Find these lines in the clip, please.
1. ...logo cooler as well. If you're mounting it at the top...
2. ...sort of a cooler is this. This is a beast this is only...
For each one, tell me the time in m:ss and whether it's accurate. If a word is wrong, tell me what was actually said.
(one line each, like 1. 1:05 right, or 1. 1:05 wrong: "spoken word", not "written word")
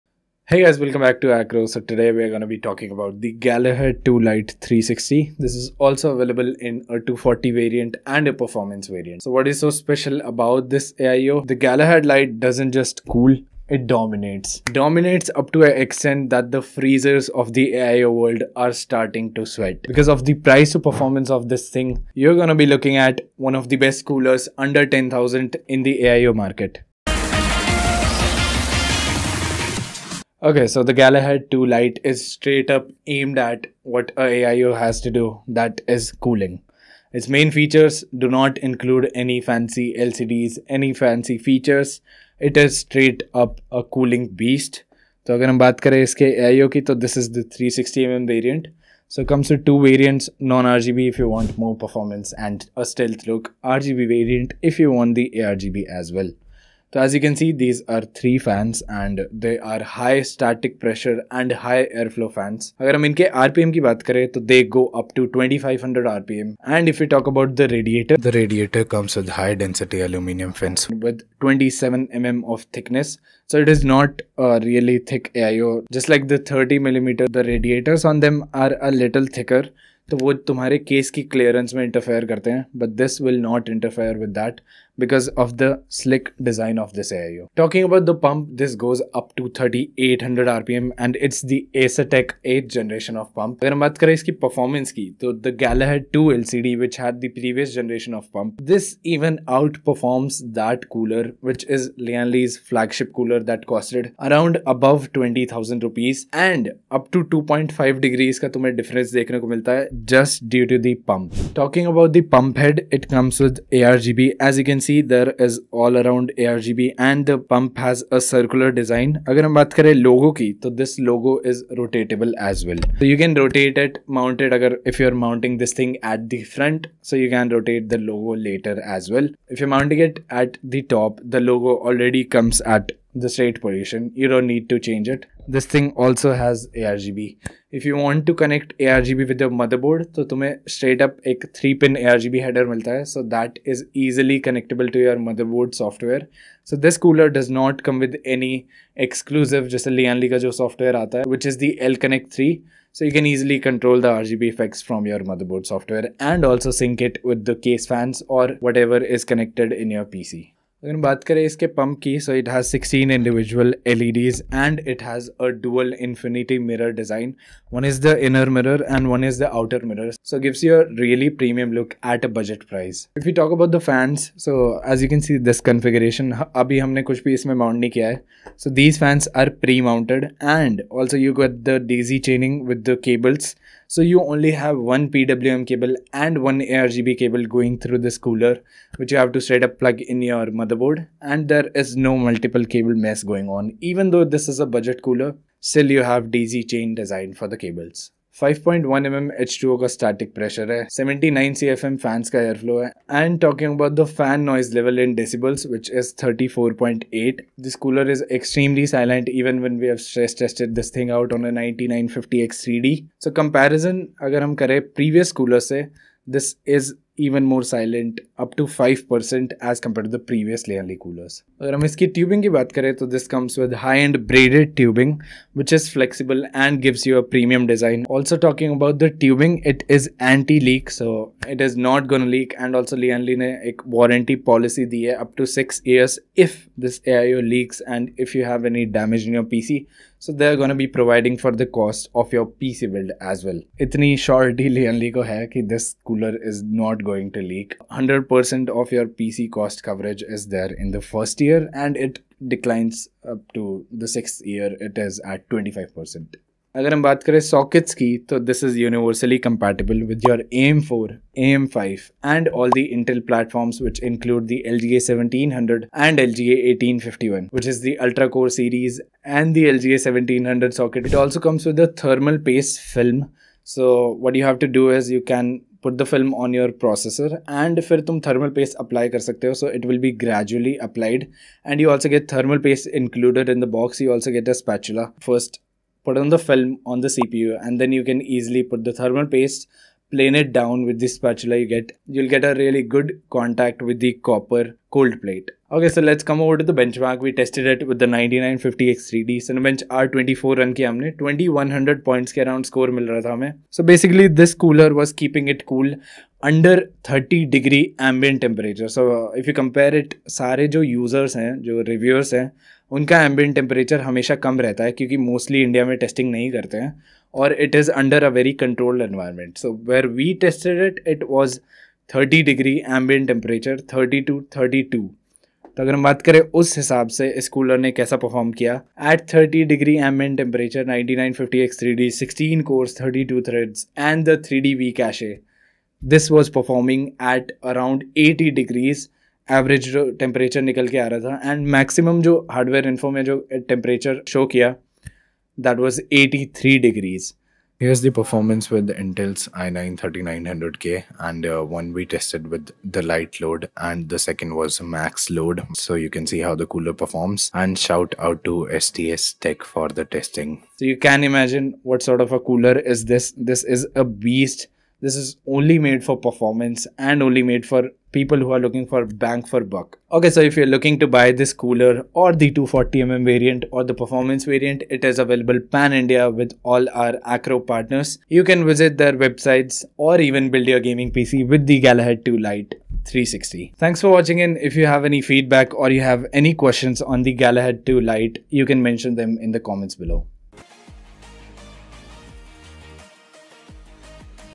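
1. 2:08 wrong: "later", not "cooler"
2. 6:02 right.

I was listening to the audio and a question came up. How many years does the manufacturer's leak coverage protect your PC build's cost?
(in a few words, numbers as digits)
6 years.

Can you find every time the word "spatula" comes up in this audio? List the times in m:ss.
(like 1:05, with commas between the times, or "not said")
4:44, 4:51.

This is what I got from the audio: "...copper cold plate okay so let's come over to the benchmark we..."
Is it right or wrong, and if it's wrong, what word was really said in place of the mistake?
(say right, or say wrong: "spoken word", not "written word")
right.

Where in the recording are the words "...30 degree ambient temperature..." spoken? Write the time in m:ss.
5:07.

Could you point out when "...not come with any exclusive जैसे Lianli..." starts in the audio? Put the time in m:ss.
2:27.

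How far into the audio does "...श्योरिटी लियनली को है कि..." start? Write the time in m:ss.
4:04.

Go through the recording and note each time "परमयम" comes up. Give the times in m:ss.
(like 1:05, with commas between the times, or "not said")
2:51, 3:47.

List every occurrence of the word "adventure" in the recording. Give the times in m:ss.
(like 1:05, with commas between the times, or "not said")
not said.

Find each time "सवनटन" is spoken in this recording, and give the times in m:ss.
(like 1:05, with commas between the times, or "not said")
4:25, 4:30.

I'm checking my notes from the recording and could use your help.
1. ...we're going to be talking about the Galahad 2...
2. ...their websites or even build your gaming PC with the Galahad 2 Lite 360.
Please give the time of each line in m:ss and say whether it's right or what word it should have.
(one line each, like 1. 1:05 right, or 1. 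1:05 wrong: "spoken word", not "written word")
1. 0:02 right
2. 6:18 right.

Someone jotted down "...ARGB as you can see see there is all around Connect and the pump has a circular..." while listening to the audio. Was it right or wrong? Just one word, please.
wrong.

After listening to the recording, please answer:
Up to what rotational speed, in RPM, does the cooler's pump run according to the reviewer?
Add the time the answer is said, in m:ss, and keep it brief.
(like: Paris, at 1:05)
3800 RPM, at 1:29.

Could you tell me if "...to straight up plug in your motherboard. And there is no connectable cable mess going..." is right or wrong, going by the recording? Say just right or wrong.
wrong.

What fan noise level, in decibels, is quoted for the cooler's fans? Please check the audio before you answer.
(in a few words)
34.8.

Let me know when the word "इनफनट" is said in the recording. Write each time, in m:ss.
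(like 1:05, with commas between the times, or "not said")
2:46.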